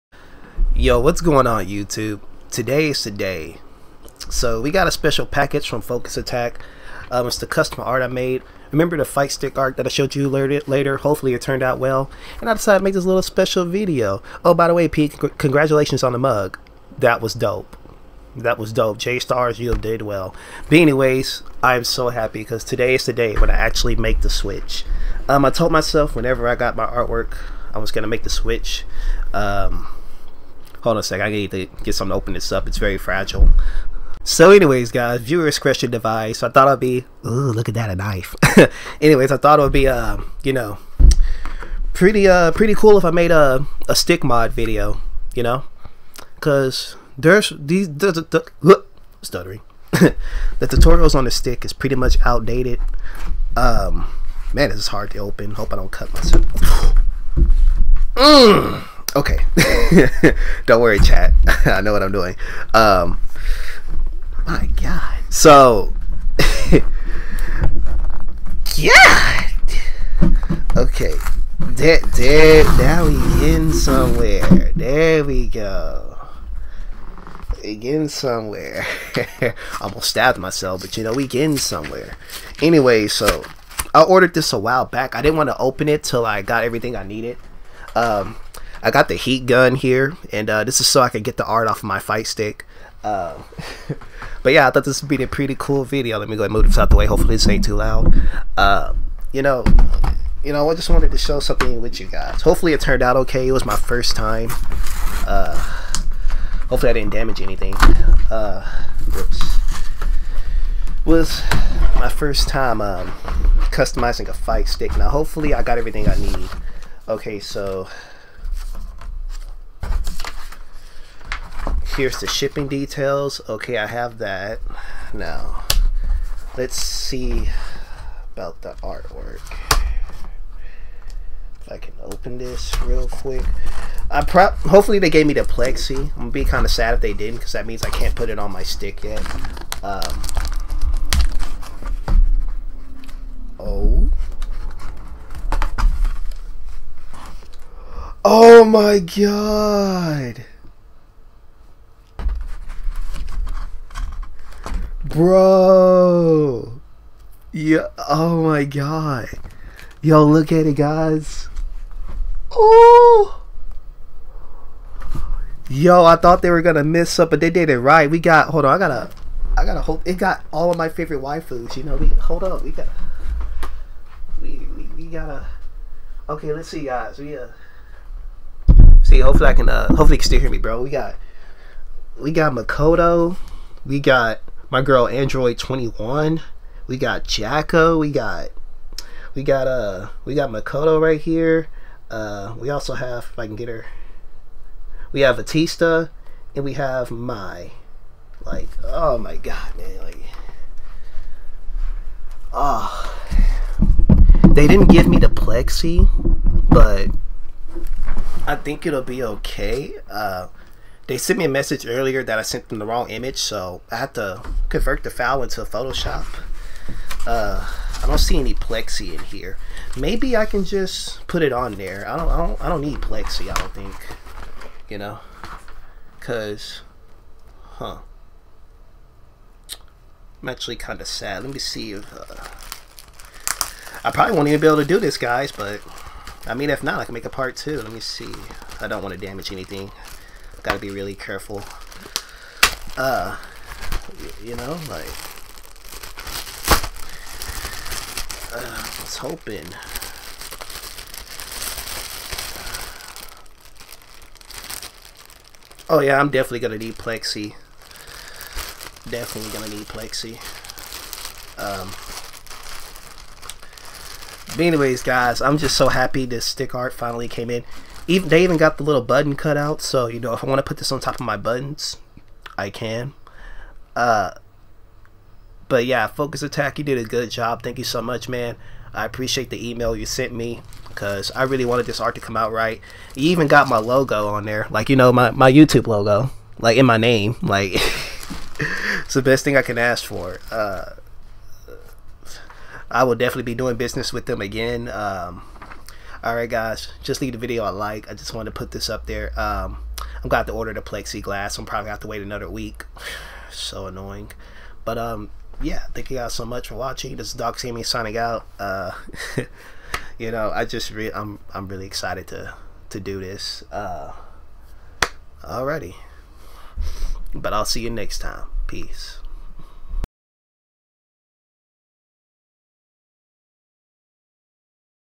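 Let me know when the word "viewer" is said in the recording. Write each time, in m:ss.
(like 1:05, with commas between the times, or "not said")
0:35.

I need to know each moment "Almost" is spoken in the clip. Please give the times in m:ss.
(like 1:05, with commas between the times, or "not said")
1:19.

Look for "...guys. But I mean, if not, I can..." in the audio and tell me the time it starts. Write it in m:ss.
3:55.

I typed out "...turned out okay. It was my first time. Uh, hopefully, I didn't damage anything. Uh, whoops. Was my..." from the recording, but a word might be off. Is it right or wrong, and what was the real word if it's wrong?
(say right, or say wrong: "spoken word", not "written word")
right.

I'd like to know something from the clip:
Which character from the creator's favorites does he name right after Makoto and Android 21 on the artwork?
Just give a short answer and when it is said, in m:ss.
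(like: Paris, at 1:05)
Jack-O, at 3:07.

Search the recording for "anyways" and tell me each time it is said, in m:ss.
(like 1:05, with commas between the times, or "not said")
0:20, 0:34, 0:39, 1:22, 4:24.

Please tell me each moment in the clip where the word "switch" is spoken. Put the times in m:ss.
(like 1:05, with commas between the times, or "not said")
0:24, 0:28.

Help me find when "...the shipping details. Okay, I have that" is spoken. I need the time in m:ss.
2:02.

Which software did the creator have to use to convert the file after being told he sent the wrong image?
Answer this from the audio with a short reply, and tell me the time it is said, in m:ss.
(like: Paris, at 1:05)
Photoshop, at 3:35.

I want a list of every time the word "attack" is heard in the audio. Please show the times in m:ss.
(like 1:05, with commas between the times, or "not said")
0:06, 4:36.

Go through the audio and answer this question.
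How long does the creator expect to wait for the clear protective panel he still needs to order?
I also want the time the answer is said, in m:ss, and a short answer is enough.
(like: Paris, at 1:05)
another week, at 5:02.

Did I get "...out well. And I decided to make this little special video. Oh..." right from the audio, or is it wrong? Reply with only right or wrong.
right.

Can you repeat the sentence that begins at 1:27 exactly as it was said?
Um, I got the heat gun here, and uh, this is so I can get the art off of my fight stick.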